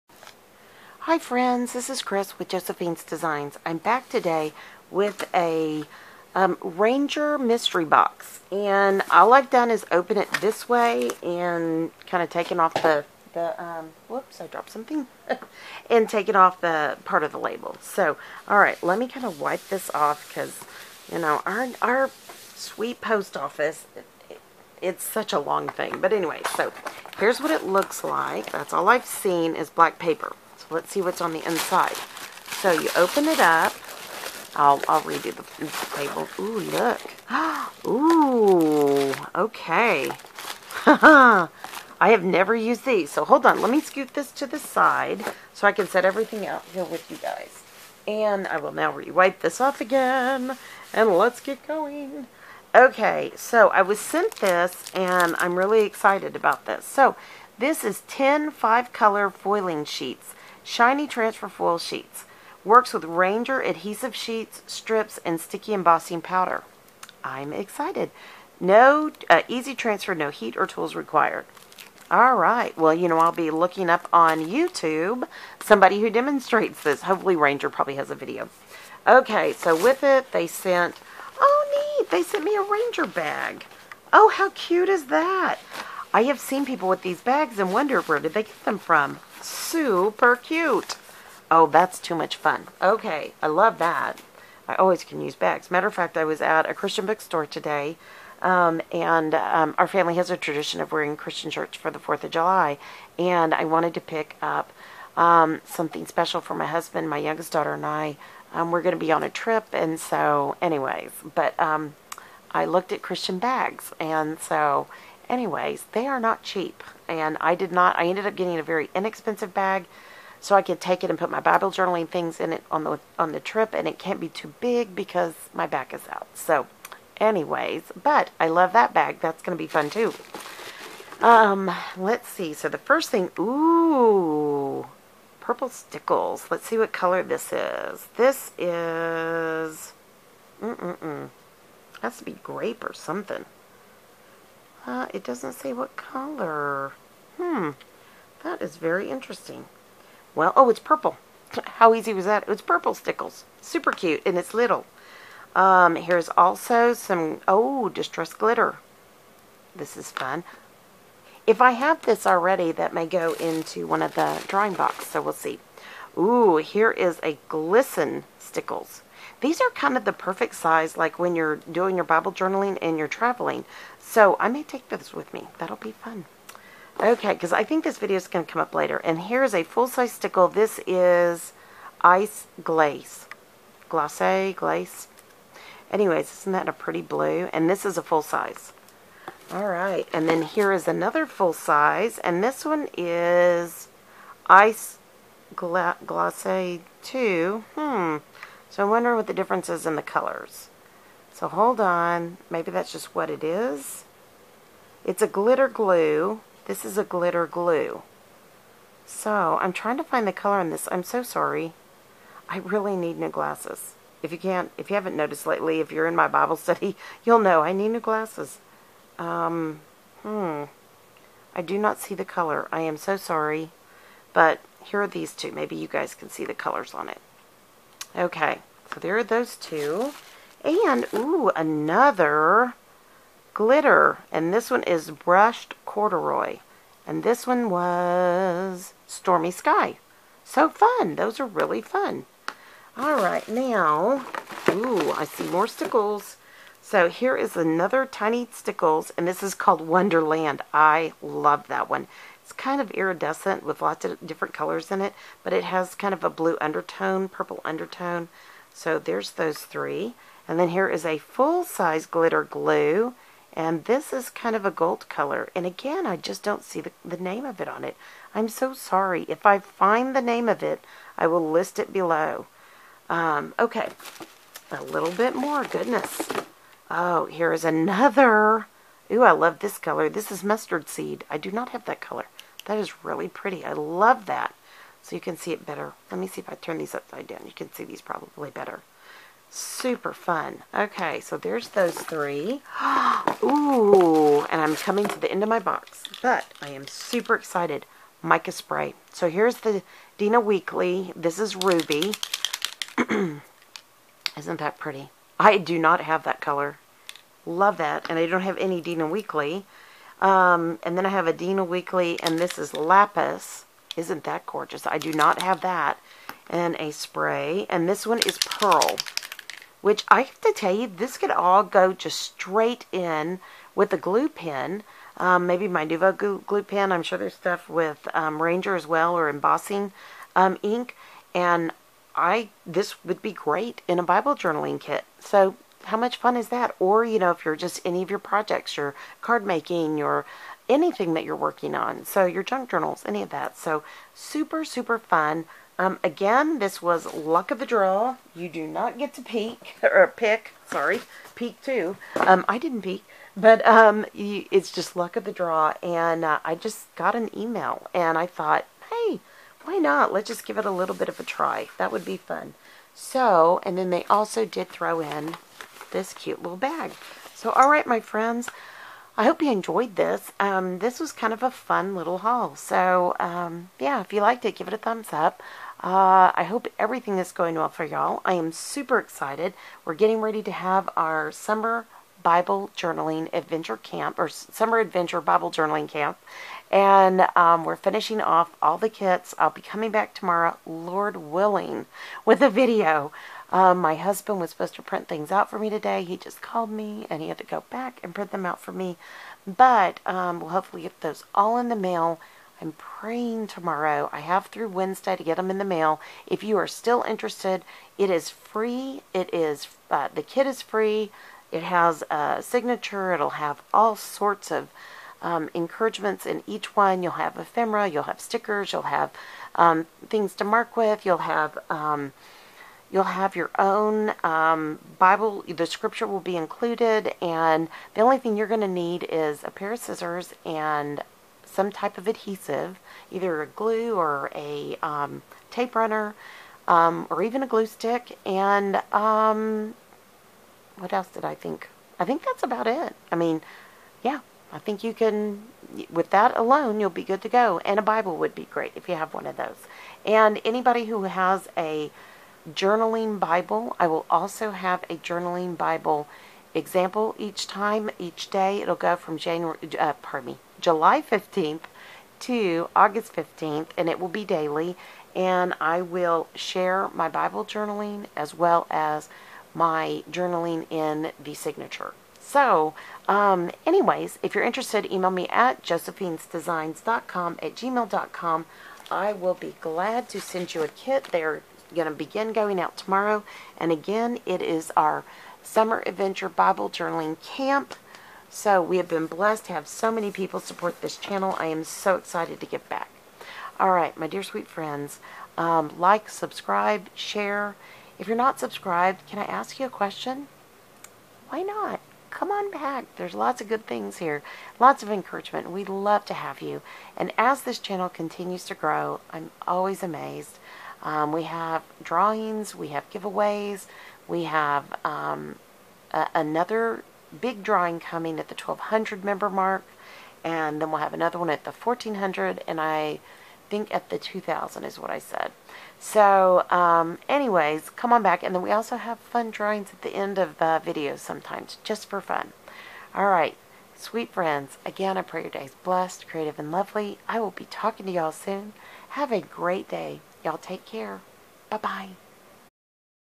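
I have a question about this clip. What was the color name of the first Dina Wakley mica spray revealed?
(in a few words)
Ruby.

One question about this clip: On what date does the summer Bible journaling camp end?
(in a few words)
August 15th.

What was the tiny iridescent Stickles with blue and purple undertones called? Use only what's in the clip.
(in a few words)
Wonderland.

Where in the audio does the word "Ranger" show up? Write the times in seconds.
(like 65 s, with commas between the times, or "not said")
6 s, 63 s, 77 s, 82 s, 328 s.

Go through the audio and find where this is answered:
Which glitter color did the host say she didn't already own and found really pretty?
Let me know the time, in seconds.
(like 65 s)
280 s.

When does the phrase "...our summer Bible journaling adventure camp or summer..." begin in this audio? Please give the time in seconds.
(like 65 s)
380 s.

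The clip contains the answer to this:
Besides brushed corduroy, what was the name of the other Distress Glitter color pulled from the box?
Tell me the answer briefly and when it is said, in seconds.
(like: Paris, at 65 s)
Stormy Sky, at 239 s.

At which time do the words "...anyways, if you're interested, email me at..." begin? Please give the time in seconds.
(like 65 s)
473 s.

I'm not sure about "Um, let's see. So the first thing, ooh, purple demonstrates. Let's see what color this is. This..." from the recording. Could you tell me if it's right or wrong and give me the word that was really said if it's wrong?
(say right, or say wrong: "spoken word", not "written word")
wrong: "stickles", not "demonstrates".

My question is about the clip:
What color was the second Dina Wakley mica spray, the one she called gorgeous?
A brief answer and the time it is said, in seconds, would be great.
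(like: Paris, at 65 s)
Lapis, at 312 s.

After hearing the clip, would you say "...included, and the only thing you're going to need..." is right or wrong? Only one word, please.
right.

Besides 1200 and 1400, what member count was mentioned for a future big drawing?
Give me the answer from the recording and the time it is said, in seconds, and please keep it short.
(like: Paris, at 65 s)
2000, at 523 s.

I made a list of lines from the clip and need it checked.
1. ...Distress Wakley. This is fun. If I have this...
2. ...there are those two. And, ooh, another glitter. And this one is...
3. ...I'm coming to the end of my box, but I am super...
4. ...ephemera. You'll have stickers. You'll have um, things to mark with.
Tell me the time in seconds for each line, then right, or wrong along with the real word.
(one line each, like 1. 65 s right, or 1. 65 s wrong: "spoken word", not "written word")
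1. 157 s wrong: "Glitter", not "Wakley"
2. 228 s right
3. 294 s right
4. 417 s right.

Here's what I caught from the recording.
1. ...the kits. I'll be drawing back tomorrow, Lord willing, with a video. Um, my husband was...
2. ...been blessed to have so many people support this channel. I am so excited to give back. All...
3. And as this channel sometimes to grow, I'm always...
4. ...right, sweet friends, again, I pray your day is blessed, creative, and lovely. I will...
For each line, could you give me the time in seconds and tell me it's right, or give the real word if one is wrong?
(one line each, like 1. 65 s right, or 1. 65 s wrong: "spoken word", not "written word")
1. 388 s wrong: "coming", not "drawing"
2. 488 s right
3. 506 s wrong: "continues", not "sometimes"
4. 533 s right.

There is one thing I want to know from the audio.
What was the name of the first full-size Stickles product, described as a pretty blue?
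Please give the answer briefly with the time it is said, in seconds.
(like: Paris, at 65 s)
Ice Glaze, at 182 s.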